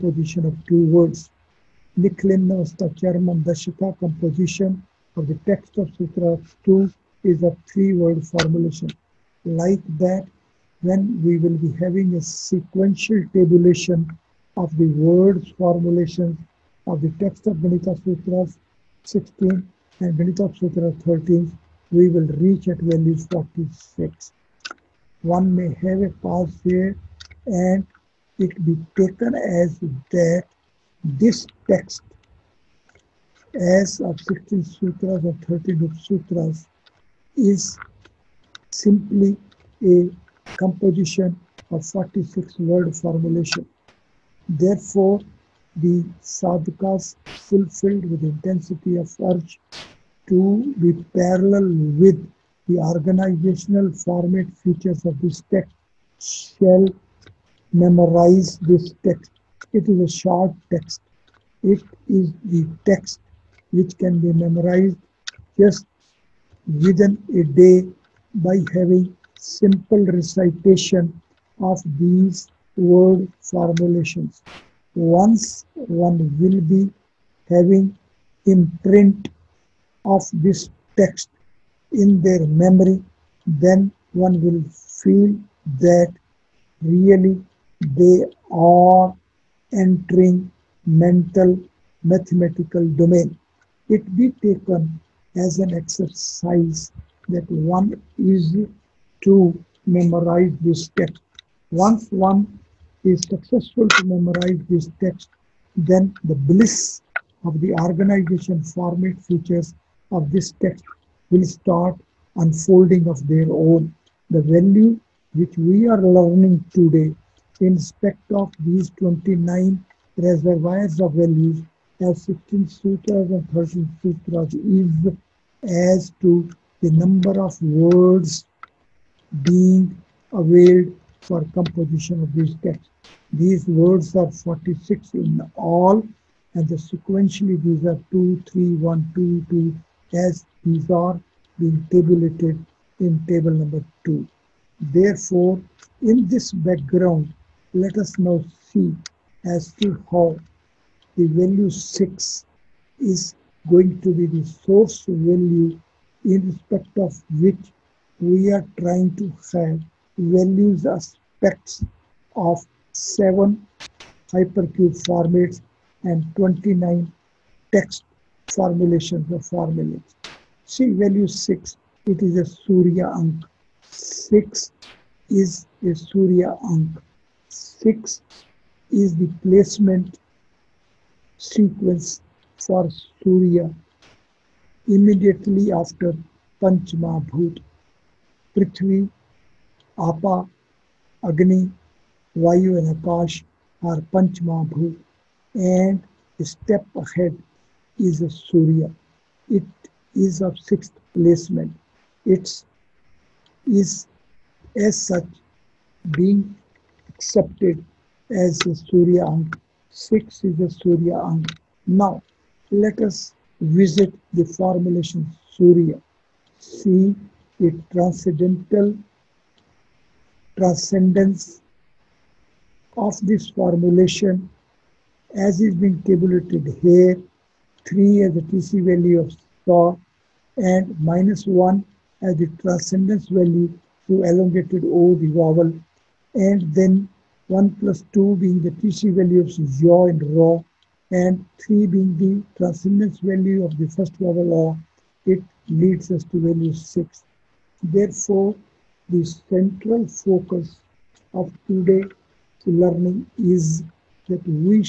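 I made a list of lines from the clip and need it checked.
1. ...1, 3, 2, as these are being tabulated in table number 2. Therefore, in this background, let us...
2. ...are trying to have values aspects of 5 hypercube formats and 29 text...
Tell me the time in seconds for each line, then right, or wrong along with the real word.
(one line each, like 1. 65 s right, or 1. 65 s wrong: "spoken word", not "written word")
1. 138 s wrong: "2", not "3"
2. 158 s wrong: "7", not "5".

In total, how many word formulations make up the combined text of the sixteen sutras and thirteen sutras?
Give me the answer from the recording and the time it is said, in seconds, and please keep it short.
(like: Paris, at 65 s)
46, at 41 s.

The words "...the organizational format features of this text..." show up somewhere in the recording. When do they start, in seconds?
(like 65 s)
52 s.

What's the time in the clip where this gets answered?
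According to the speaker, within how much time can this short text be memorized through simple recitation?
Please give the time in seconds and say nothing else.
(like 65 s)
66 s.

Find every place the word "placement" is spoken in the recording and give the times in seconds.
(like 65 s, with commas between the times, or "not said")
179 s, 201 s.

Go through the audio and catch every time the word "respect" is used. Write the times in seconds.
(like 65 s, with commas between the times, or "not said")
117 s, 156 s.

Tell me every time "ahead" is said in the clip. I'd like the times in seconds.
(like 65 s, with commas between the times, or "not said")
197 s.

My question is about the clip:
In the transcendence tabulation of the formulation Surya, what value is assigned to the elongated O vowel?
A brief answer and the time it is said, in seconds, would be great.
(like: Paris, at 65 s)
-1, at 231 s.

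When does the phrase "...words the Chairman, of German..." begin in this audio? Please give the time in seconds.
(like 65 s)
0 s.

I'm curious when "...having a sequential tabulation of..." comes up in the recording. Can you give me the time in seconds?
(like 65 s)
11 s.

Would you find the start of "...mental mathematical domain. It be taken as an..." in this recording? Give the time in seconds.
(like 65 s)
90 s.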